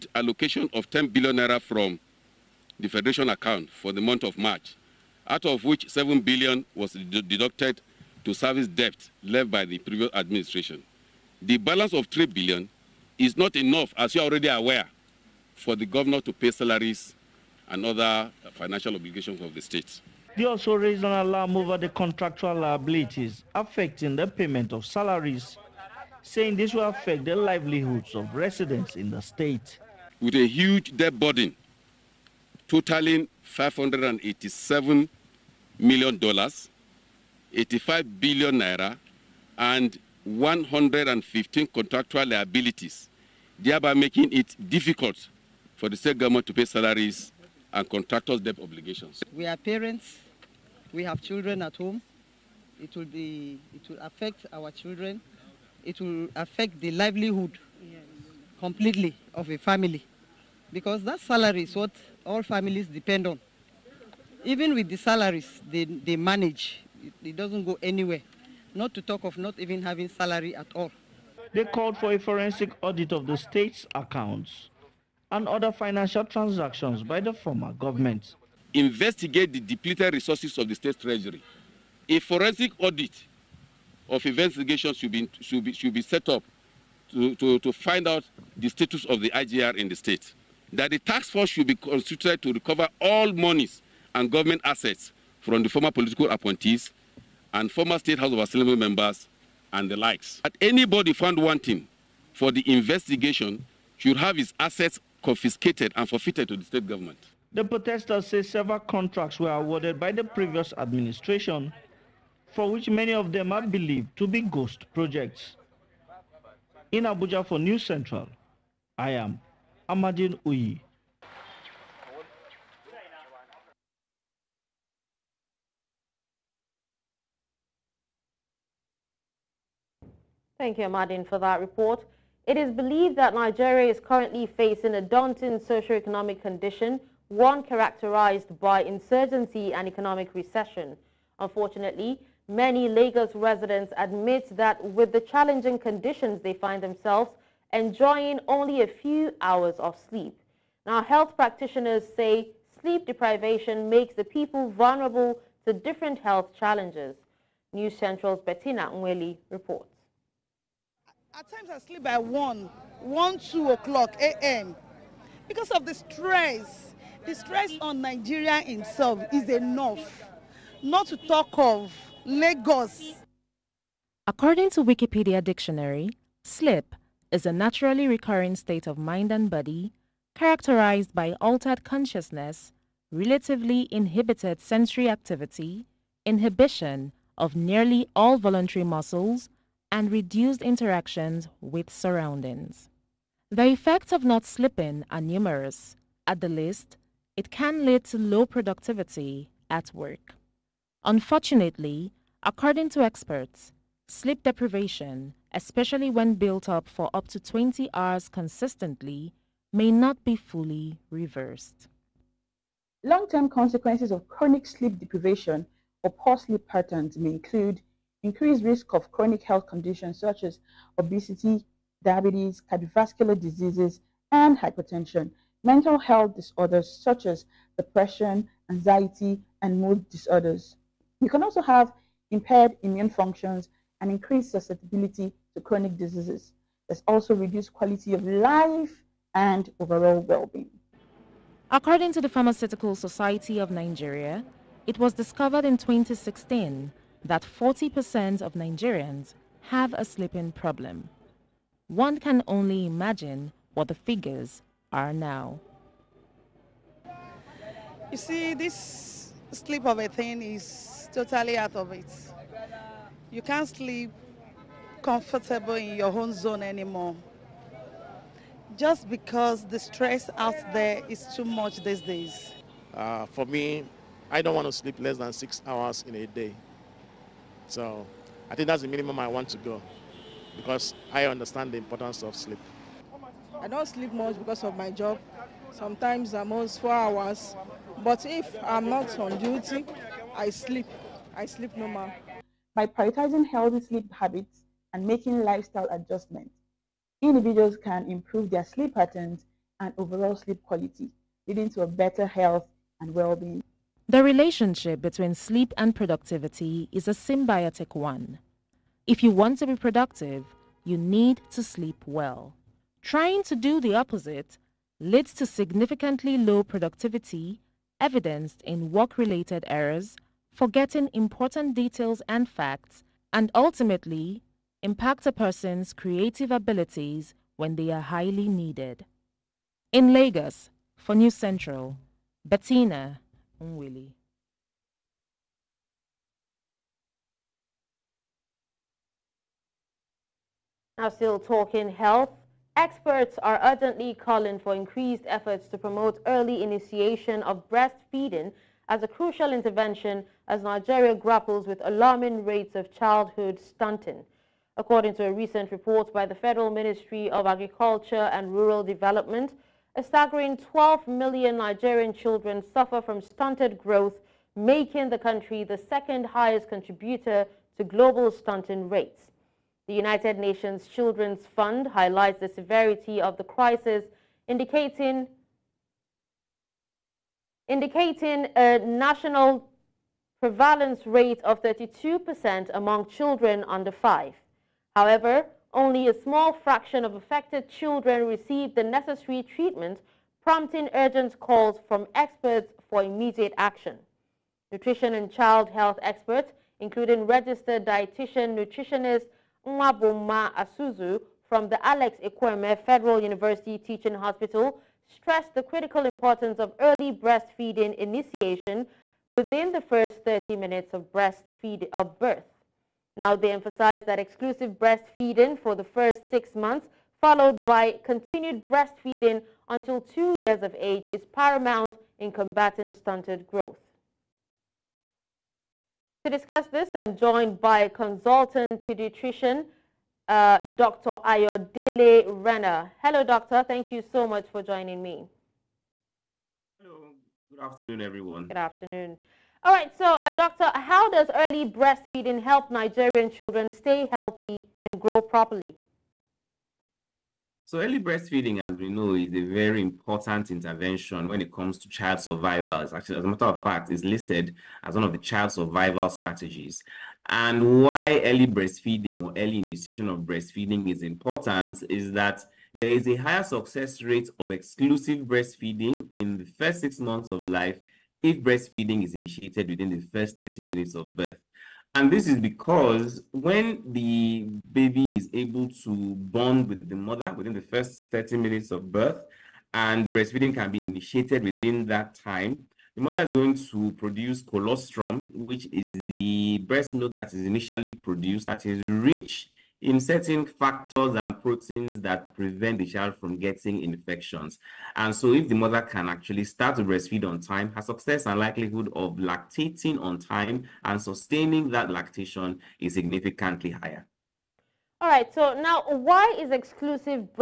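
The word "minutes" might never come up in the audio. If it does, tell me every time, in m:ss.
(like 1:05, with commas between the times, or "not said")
6:50, 7:50, 7:58.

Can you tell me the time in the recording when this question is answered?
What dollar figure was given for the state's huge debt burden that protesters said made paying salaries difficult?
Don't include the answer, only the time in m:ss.
0:33.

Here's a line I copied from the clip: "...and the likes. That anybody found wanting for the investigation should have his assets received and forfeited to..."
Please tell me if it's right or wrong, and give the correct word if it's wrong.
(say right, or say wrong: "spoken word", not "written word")
wrong: "confiscated", not "received".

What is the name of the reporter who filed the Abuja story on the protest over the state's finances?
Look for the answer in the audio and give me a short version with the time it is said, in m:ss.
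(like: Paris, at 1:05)
Amadin Uyi, at 1:59.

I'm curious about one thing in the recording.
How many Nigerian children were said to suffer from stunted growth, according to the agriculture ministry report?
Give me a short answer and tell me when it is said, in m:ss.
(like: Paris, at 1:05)
12 million, at 6:00.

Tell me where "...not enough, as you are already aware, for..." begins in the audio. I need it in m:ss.
0:13.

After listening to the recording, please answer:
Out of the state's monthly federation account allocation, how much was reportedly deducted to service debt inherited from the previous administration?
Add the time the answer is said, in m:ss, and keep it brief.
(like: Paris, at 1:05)
7 billion naira, at 0:05.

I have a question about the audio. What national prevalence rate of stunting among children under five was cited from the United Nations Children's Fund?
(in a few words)
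32%.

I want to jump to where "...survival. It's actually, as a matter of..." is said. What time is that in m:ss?
7:32.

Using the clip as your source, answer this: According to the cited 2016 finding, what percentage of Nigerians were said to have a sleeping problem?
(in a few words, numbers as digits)
40%.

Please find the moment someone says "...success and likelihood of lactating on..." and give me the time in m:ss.
8:17.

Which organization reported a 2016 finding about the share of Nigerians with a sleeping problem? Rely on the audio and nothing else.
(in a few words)
Pharmaceutical Society of Nigeria.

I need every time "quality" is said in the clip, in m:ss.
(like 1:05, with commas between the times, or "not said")
3:57, 5:00.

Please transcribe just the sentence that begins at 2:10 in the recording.
Thank you, Amadin, for that report.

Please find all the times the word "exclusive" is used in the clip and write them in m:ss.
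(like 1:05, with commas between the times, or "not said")
6:54, 7:44, 8:26.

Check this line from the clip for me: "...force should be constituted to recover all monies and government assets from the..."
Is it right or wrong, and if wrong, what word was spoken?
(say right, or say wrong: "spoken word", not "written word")
right.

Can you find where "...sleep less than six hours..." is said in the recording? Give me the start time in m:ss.
4:34.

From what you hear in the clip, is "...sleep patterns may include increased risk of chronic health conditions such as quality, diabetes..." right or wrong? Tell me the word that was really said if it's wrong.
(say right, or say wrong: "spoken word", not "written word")
wrong: "obesity", not "quality".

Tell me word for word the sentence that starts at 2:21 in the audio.
Unfortunately, many Lagos residents admit that with the challenging conditions they find themselves, enjoying only a few hours of sleep.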